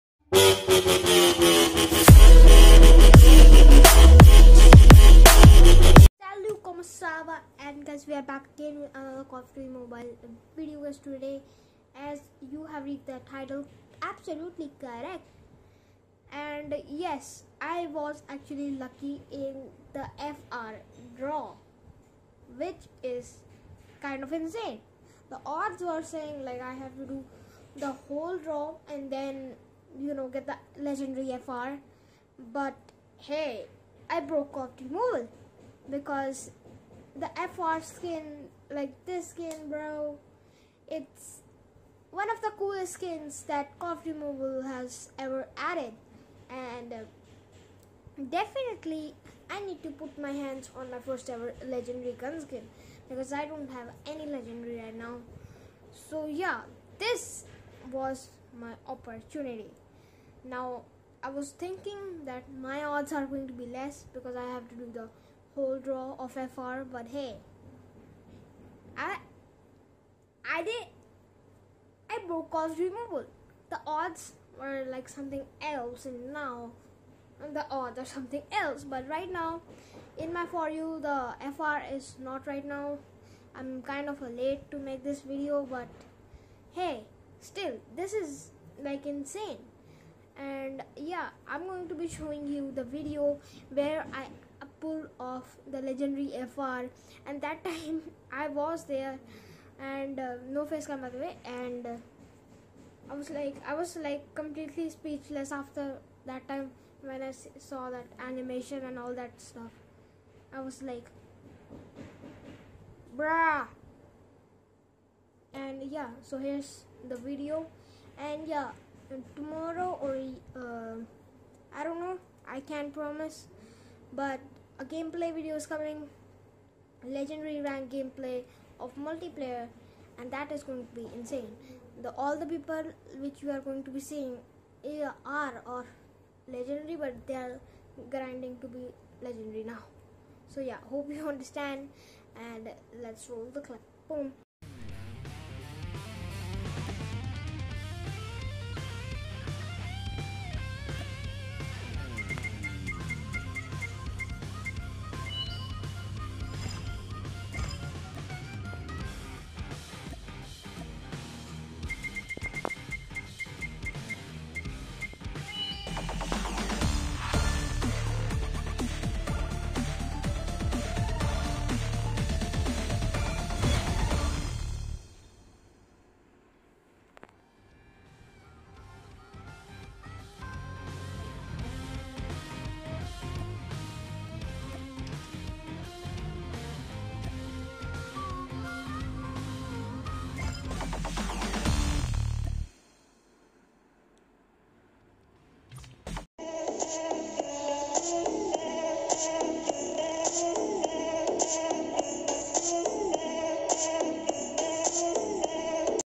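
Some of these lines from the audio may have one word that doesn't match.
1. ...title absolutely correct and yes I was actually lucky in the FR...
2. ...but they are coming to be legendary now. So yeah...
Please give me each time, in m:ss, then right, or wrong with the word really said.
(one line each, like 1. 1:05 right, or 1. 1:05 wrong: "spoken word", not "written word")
1. 0:13 right
2. 2:17 wrong: "grinding", not "coming".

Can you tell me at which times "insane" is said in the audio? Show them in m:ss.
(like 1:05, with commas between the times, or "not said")
0:24, 1:29, 2:11.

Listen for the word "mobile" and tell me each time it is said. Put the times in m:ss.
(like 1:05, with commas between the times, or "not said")
0:09, 0:34, 0:44.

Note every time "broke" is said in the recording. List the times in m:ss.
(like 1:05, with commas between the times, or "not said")
0:34, 1:12.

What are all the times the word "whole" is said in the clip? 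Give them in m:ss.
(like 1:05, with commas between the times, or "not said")
0:28, 1:05.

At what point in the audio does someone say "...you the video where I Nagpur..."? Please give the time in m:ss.
1:32.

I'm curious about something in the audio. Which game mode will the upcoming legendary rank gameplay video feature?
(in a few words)
Multiplayer.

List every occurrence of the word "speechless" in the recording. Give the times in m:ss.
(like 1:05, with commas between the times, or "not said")
1:44.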